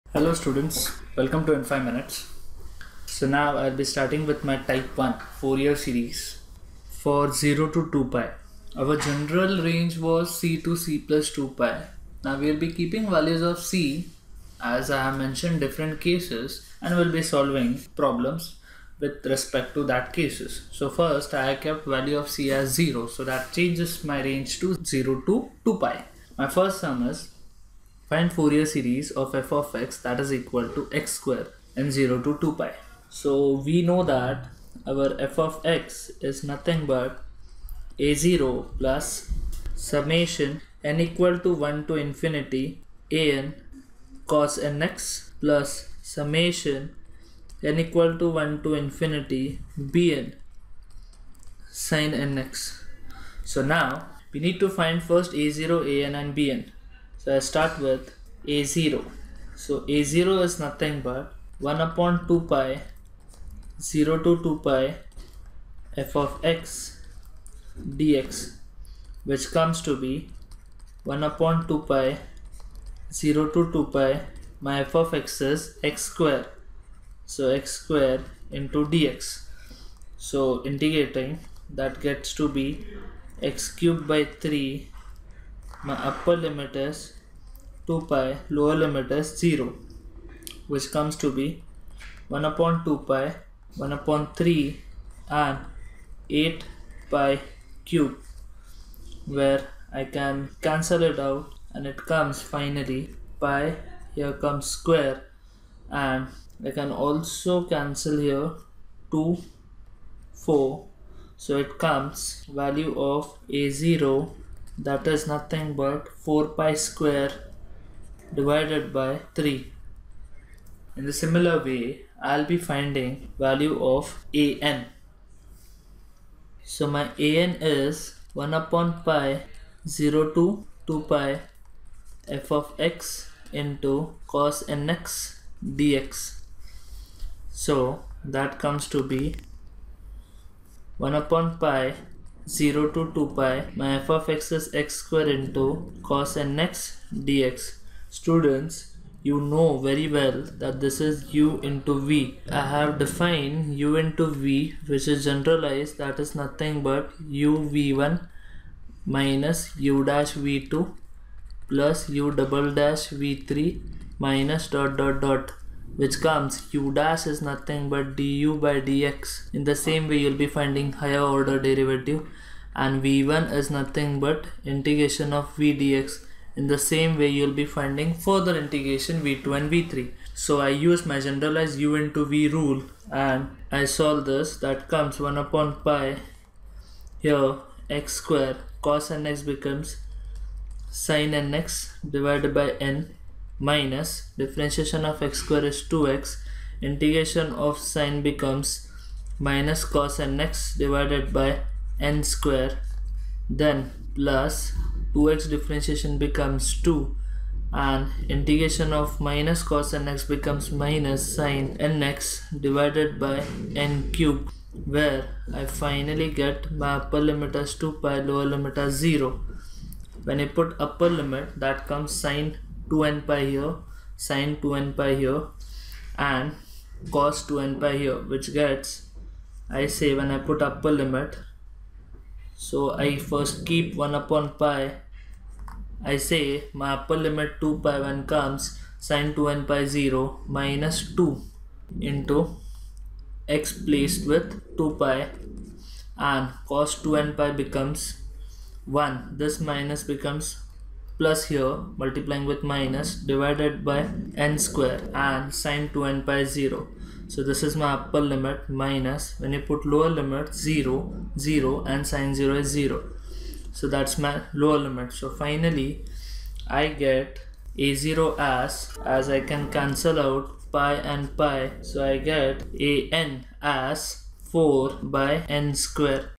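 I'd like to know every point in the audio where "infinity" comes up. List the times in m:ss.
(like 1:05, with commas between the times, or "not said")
0:41, 0:48.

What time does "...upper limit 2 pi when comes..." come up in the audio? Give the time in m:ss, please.
3:56.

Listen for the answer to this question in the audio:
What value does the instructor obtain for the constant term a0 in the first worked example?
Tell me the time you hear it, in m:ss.
1:56.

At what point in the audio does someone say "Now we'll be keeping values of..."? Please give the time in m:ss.
0:12.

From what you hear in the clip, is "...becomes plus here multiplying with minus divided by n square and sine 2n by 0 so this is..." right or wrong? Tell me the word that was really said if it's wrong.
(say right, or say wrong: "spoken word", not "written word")
right.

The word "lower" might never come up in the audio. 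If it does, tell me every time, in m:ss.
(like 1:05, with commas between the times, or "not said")
1:28, 3:38, 4:19, 4:24.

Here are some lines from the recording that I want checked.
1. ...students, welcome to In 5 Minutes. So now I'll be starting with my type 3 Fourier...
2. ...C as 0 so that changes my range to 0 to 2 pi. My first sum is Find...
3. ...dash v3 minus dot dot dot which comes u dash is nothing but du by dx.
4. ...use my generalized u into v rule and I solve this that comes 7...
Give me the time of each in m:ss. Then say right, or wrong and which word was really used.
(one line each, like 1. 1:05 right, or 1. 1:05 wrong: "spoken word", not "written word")
1. 0:00 wrong: "1", not "3"
2. 0:22 right
3. 2:42 right
4. 3:00 wrong: "1", not "7".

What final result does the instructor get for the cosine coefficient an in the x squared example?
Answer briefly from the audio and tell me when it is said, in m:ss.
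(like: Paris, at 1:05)
4/n squared, at 4:34.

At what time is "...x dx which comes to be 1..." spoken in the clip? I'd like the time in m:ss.
1:06.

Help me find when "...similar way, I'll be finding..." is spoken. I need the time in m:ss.
2:01.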